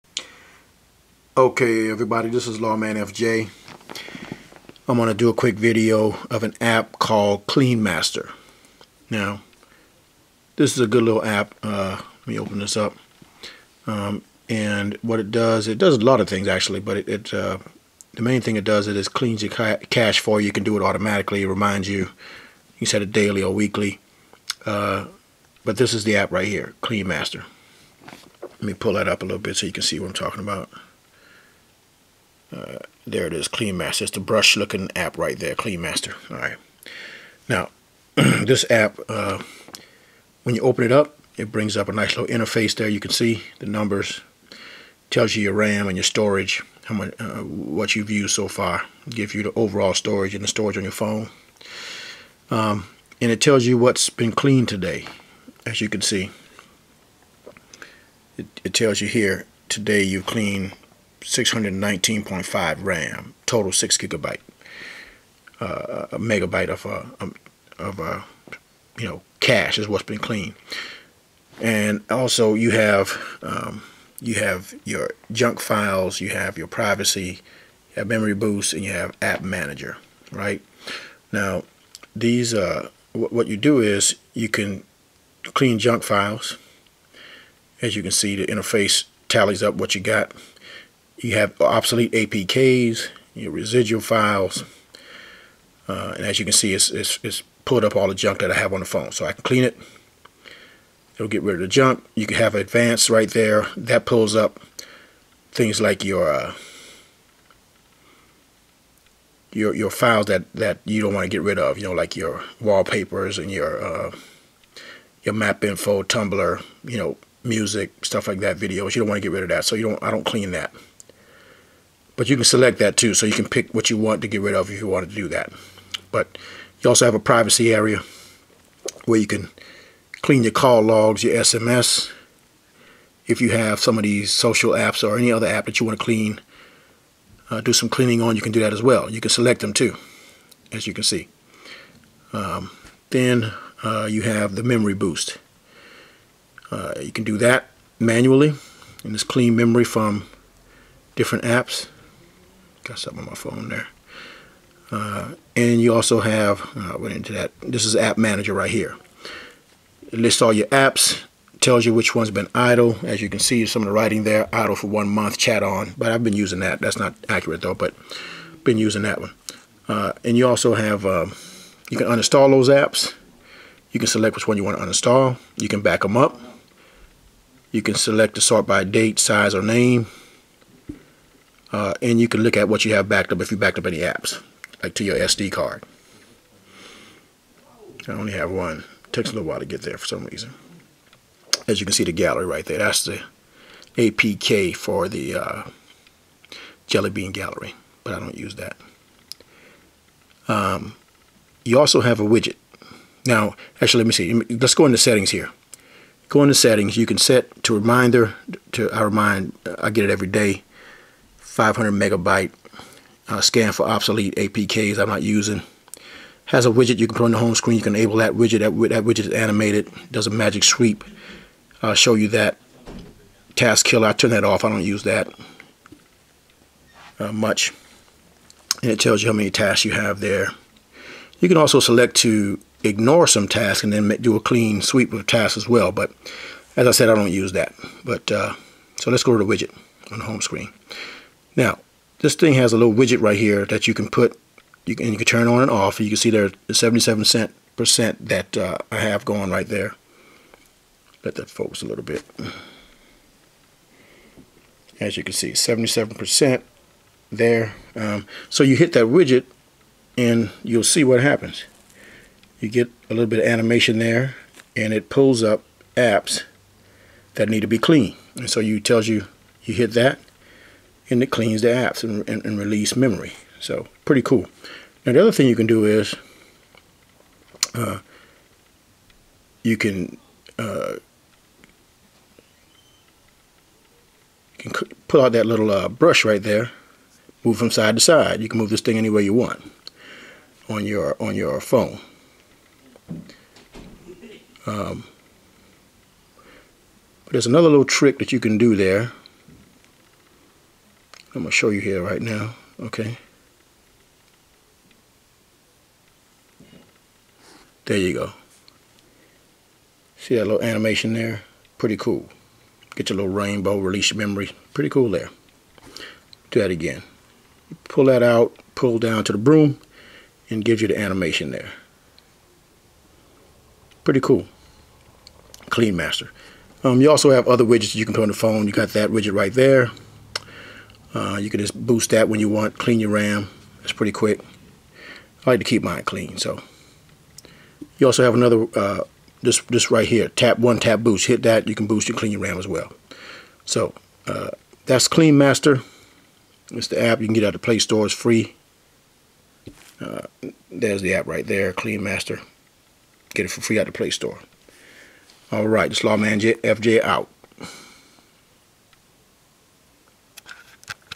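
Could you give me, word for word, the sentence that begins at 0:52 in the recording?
Um, and it tells you what's been cleaned today, as you can see.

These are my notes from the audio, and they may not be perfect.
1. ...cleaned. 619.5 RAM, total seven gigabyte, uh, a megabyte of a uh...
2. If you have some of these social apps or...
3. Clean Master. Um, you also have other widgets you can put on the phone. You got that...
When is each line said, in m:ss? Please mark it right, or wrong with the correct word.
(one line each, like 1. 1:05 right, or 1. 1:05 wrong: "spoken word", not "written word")
1. 1:00 wrong: "six", not "seven"
2. 2:13 right
3. 5:25 right.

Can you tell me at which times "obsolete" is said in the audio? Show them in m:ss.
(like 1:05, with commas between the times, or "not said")
1:31, 3:33.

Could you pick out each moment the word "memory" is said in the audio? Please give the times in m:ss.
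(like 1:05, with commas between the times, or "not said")
1:18, 2:24, 2:29, 4:32, 5:14.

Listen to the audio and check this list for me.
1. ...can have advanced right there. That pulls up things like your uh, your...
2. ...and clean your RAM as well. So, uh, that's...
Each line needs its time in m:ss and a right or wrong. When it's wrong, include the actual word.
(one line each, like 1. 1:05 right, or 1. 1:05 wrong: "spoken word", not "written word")
1. 1:42 right
2. 5:42 right.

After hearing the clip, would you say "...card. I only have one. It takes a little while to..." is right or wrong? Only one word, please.
right.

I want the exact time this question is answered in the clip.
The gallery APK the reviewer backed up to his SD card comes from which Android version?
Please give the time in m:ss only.
3:16.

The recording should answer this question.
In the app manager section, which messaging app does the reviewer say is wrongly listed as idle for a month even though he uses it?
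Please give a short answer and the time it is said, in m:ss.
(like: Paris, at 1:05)
ChatON, at 2:45.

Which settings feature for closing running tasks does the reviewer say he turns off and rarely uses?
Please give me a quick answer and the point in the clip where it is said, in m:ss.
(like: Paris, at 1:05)
Task Killer, at 3:43.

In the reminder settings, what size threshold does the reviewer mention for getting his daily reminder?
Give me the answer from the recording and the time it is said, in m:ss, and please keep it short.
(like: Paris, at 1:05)
500 megabytes, at 3:31.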